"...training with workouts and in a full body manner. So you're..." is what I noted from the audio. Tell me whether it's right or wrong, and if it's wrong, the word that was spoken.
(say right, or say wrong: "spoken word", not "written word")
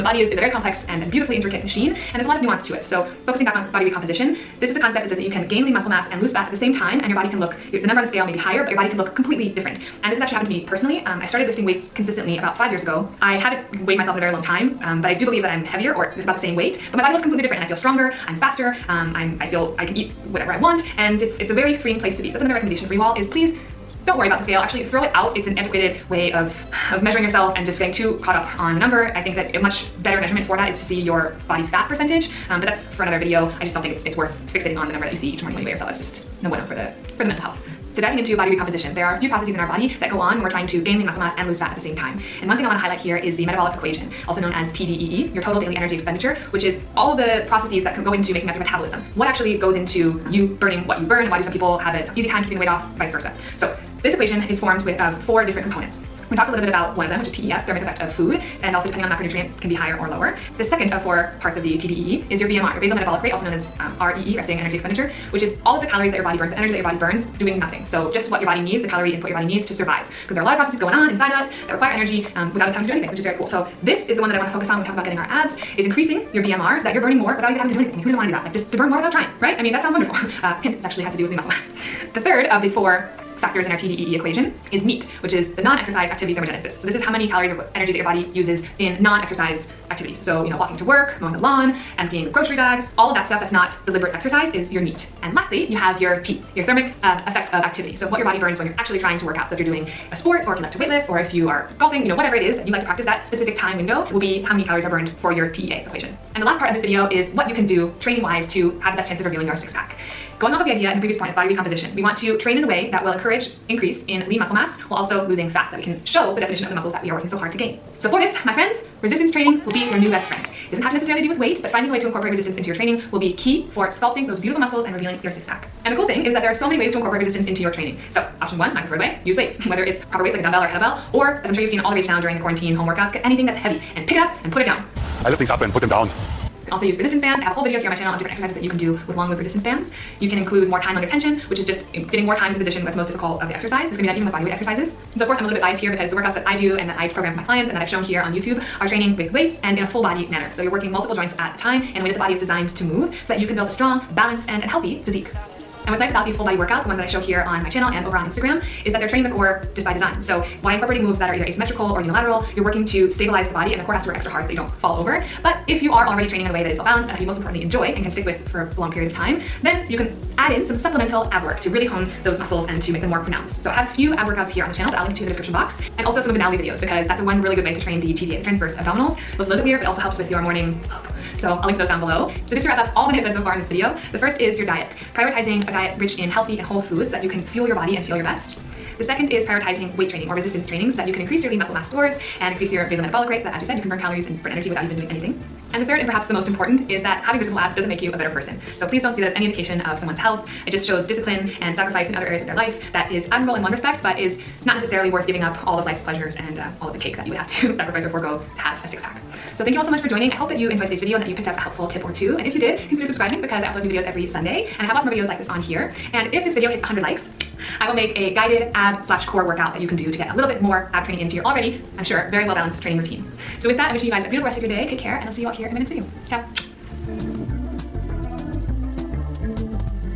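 wrong: "weights", not "workouts".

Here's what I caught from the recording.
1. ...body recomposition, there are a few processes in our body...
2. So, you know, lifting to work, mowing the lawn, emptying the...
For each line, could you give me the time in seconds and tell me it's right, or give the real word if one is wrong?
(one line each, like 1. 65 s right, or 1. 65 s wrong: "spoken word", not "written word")
1. 38 s right
2. 90 s wrong: "walking", not "lifting".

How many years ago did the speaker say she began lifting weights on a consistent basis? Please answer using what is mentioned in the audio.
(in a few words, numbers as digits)
5.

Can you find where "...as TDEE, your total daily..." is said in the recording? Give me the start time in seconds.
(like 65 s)
44 s.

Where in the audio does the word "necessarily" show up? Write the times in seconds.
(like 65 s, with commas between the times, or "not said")
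120 s, 204 s.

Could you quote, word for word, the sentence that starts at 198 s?
So please don't see that as any indication of someone's health.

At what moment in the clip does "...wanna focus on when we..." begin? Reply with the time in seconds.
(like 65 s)
74 s.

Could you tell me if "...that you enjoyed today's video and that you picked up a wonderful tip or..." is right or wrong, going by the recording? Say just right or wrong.
wrong.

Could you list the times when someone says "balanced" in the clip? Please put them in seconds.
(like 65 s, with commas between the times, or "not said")
154 s, 166 s, 222 s.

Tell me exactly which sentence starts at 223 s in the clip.
So with that, I'm wishing you guys a beautiful rest of your day.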